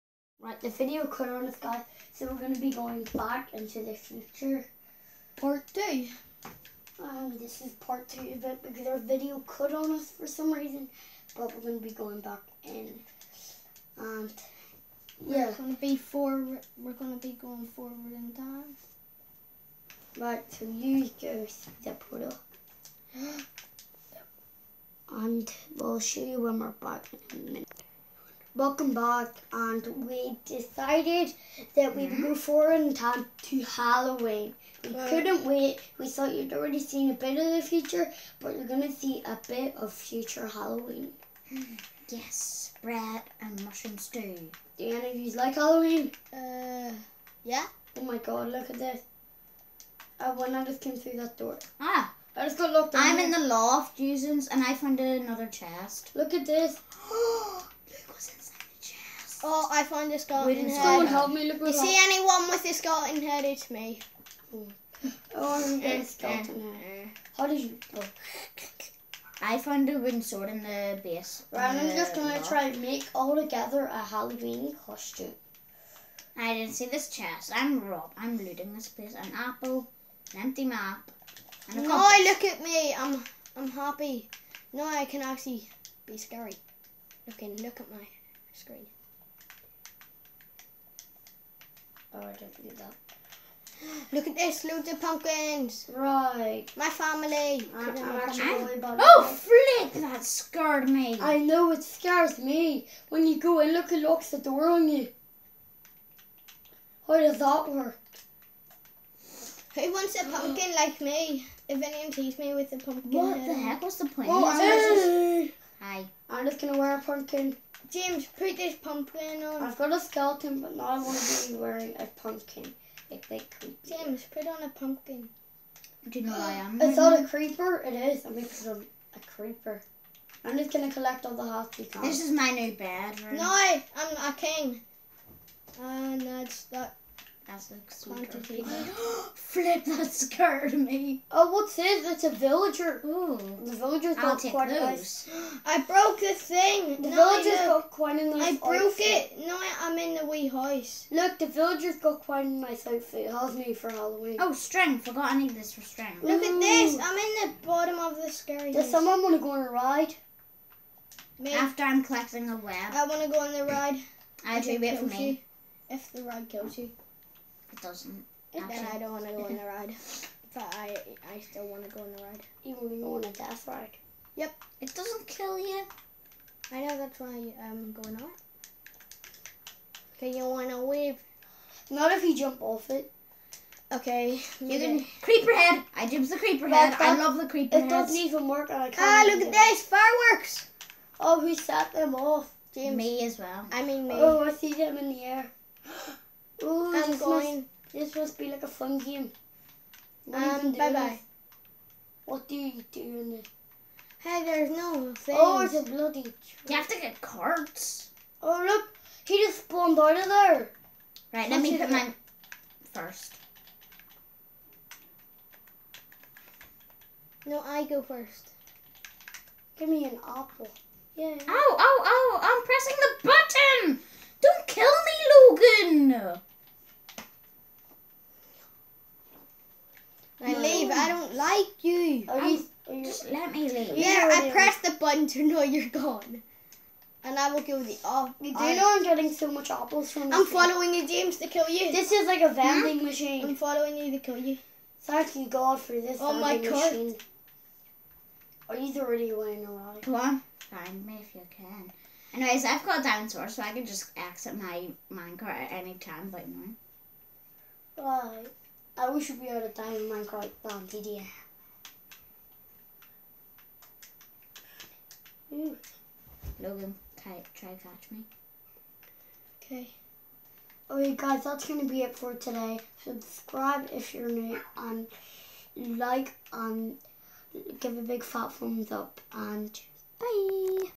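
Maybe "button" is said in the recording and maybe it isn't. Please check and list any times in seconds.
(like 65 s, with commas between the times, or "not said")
223 s, 234 s.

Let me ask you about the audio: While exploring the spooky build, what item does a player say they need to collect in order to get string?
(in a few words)
a web.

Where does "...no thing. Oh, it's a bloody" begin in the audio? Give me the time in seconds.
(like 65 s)
204 s.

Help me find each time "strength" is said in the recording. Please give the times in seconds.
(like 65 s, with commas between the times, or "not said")
154 s.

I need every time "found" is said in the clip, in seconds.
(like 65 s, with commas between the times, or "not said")
54 s, 59 s, 69 s.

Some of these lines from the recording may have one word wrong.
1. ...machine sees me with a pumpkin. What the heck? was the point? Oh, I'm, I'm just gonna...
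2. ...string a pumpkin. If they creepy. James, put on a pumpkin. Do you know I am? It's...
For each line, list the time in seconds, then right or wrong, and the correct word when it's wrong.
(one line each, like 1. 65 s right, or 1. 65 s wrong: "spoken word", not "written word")
1. 111 s wrong: "anyone", not "machine"
2. 121 s wrong: "wearing", not "string".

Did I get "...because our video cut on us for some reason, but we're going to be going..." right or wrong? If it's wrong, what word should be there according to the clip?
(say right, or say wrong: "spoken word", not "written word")
right.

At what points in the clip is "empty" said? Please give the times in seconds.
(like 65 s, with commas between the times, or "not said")
80 s.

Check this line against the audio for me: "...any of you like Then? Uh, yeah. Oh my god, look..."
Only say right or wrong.
wrong.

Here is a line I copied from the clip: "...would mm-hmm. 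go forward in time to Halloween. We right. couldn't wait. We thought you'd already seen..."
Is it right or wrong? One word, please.
right.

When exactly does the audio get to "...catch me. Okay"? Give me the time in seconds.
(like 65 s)
267 s.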